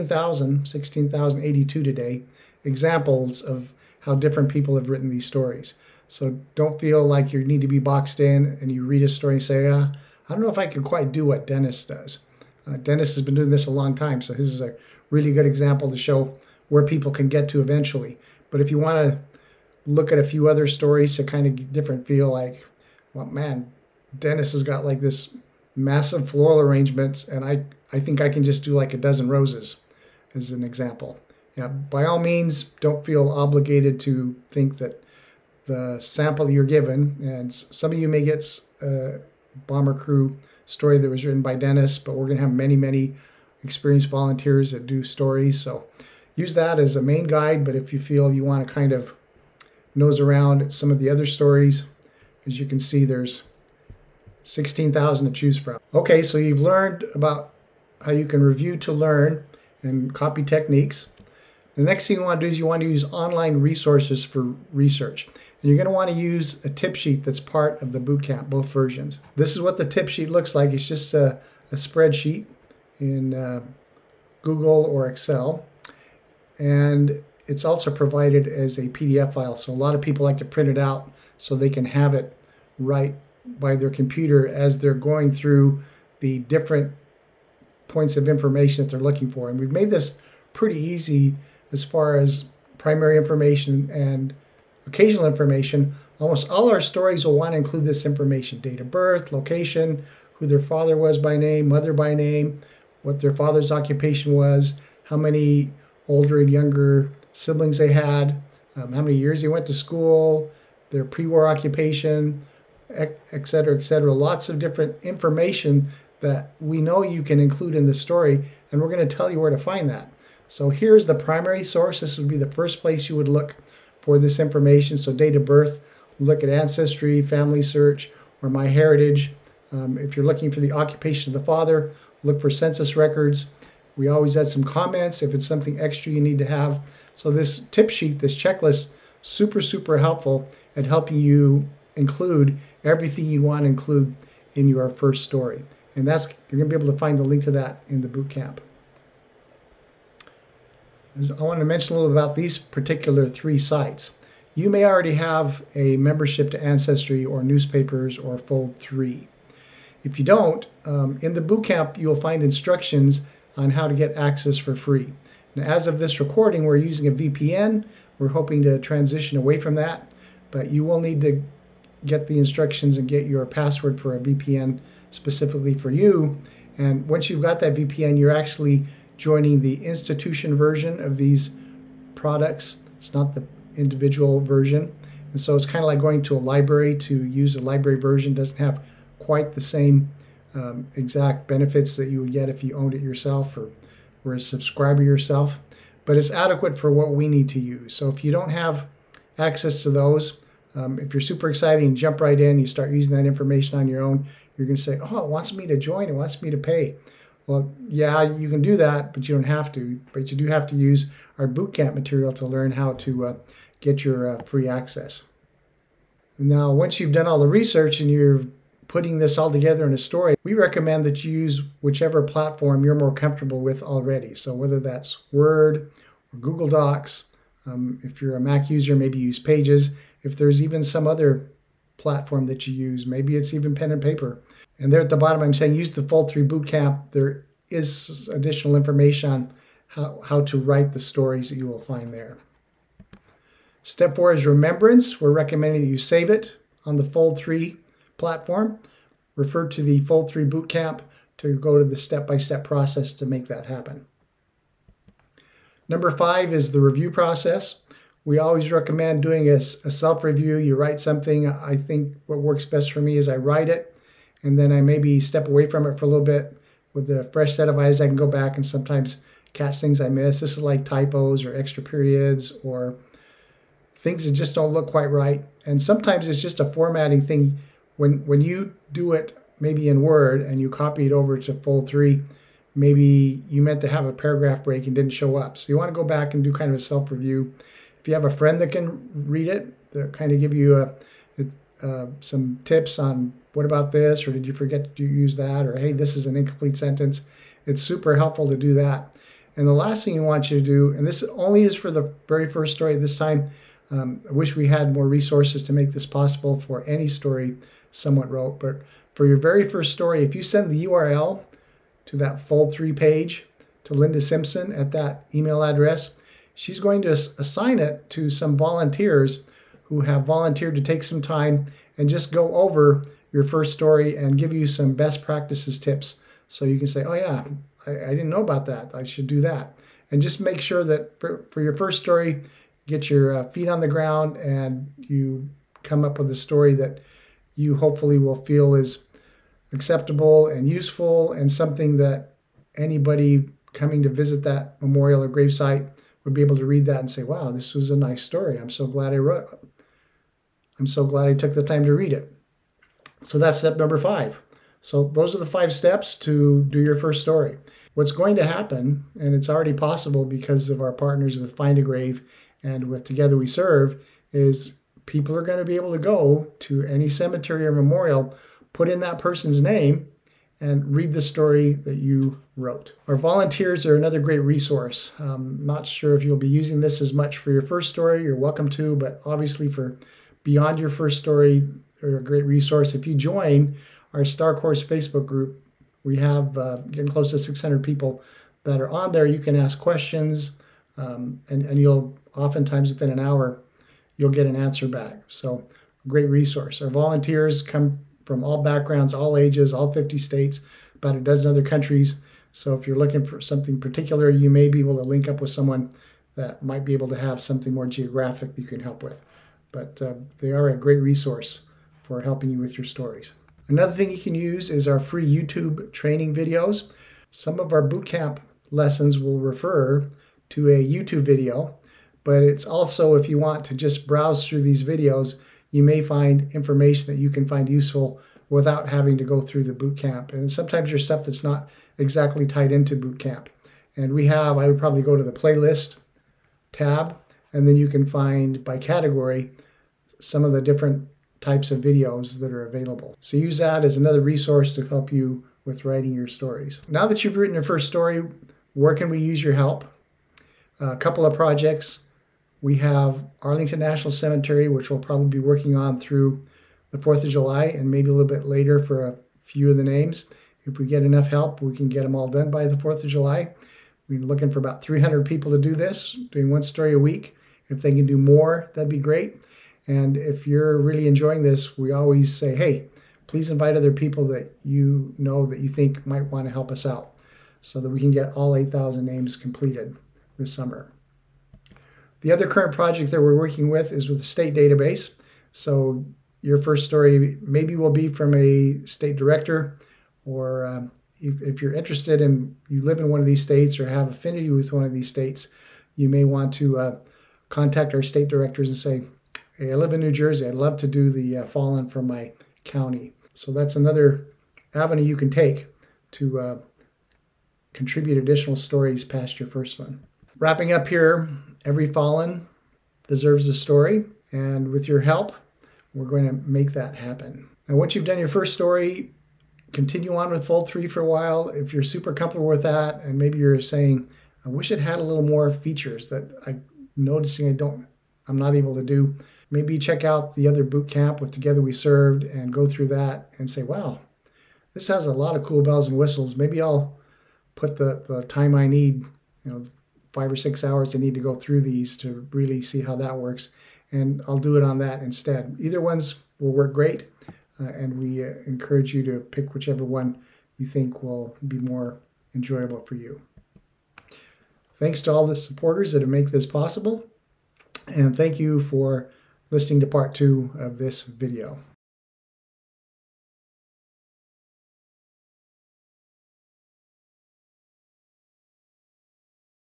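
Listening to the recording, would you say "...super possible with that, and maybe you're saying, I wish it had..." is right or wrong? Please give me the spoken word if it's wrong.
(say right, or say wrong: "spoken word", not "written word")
wrong: "comfortable", not "possible".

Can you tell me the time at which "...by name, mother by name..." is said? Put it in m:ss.
1:41.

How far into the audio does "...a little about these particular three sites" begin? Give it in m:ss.
2:31.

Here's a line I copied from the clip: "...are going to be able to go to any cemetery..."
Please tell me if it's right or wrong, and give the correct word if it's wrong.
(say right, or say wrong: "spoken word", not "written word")
right.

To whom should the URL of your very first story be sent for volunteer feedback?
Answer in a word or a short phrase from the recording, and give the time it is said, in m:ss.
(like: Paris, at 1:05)
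Linda Simpson, at 5:13.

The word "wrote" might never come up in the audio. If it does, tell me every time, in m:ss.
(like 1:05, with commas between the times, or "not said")
5:08, 5:49, 6:12.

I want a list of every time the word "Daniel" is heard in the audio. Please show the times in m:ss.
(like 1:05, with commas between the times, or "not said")
not said.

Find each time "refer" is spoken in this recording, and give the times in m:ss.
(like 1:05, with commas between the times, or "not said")
4:09, 6:59.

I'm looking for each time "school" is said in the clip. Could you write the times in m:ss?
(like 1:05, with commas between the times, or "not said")
1:49.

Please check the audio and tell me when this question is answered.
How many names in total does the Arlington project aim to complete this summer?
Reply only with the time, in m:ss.
7:58.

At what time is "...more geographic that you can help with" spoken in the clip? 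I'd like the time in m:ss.
6:47.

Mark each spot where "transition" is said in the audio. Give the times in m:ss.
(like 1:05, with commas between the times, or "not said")
2:48.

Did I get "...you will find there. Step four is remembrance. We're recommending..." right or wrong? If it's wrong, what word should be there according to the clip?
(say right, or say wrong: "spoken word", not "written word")
right.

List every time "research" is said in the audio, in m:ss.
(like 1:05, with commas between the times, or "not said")
1:04, 3:37.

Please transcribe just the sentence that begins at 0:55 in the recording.
Okay, so you've learned about how you can review to learn and copy techniques.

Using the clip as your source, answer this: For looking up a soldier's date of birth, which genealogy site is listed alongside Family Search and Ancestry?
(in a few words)
My Heritage.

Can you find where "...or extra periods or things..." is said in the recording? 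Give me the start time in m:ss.
4:31.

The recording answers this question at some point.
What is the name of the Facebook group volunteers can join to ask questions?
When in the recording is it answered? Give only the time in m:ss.
6:24.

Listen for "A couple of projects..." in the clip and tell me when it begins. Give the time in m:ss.
7:30.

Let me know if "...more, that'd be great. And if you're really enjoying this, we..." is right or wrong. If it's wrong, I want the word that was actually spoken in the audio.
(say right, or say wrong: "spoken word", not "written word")
right.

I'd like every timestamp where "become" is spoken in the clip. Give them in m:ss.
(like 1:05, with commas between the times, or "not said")
not said.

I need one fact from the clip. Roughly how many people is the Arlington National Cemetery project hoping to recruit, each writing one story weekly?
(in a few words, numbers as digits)
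300.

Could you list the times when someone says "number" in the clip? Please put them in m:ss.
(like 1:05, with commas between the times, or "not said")
4:15, 5:53.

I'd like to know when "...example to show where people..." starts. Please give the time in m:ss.
0:15.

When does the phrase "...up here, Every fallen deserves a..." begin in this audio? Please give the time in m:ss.
8:30.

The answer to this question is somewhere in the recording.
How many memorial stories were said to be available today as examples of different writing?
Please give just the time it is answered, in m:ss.
0:00.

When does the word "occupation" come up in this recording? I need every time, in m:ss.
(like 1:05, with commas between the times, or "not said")
1:43, 1:51, 2:10.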